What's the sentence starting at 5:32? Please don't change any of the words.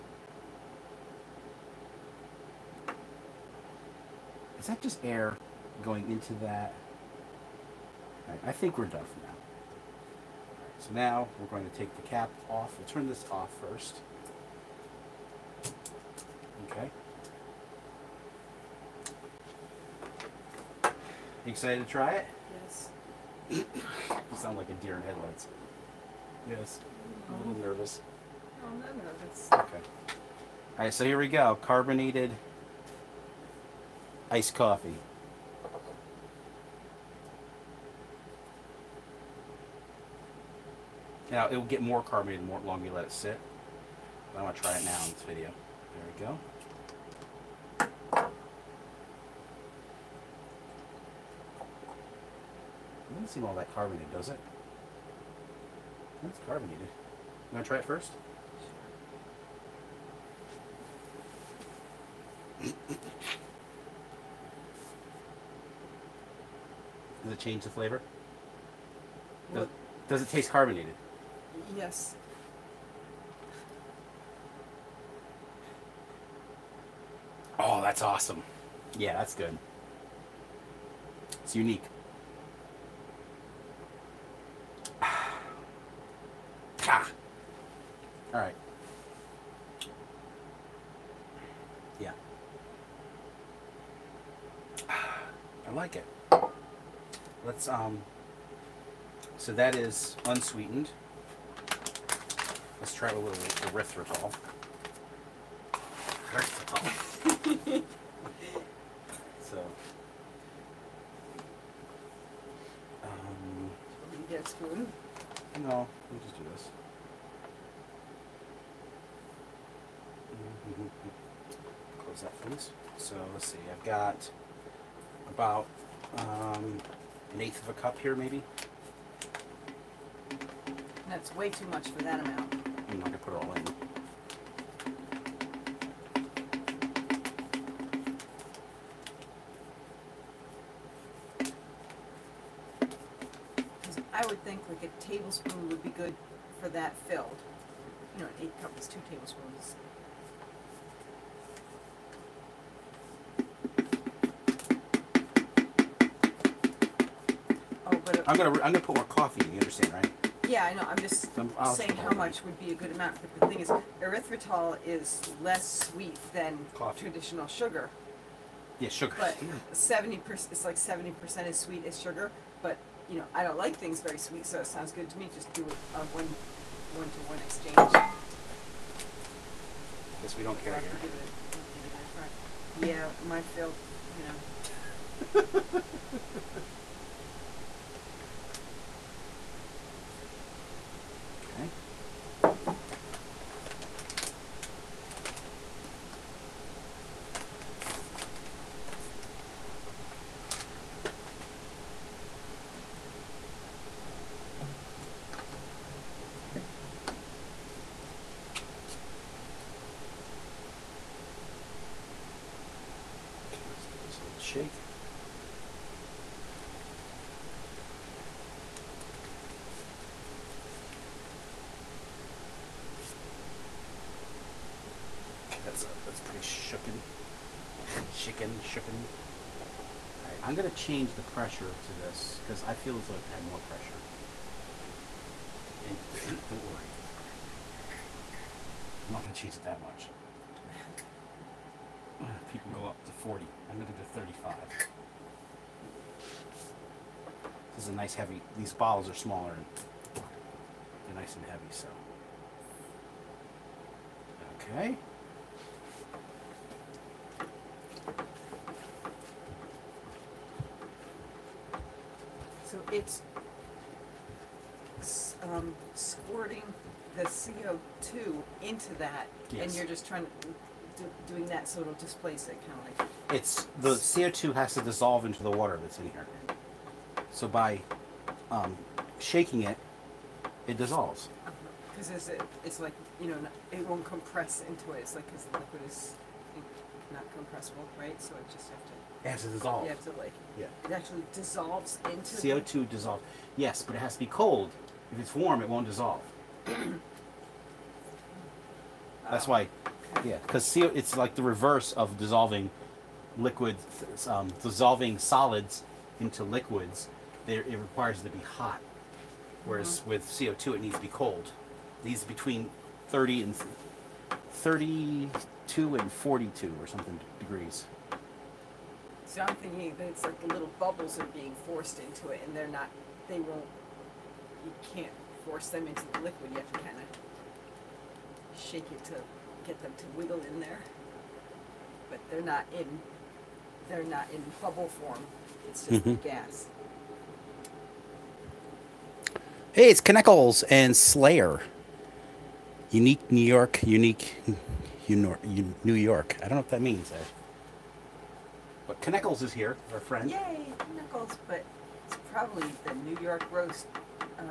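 But they're not in they're not in bubble form.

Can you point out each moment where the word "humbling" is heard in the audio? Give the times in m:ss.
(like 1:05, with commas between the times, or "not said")
not said.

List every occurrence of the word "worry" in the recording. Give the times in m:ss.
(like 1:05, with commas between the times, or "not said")
3:56.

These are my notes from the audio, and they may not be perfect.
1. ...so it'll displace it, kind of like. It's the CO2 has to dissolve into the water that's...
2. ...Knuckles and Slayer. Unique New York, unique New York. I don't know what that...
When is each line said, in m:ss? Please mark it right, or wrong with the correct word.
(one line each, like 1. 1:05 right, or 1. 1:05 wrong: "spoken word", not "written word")
1. 4:31 right
2. 5:40 right.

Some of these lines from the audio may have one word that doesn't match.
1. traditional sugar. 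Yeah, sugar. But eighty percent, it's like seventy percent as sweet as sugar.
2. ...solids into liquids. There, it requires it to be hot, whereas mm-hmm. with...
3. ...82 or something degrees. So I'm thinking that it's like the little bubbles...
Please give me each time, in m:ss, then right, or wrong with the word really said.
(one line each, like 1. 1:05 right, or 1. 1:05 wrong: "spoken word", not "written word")
1. 2:47 wrong: "seventy", not "eighty"
2. 5:05 right
3. 5:16 wrong: "42", not "82".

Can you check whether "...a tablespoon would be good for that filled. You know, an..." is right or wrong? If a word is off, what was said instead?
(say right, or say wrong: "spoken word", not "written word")
right.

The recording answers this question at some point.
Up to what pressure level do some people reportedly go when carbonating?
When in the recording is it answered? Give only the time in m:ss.
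4:03.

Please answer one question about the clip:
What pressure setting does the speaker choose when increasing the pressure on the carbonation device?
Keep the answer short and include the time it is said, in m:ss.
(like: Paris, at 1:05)
35, at 4:04.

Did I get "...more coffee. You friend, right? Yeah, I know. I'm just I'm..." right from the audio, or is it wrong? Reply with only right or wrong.
wrong.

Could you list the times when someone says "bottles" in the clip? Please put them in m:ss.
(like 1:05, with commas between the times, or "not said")
4:08.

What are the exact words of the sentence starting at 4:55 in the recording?
If it's warm, it won't dissolve.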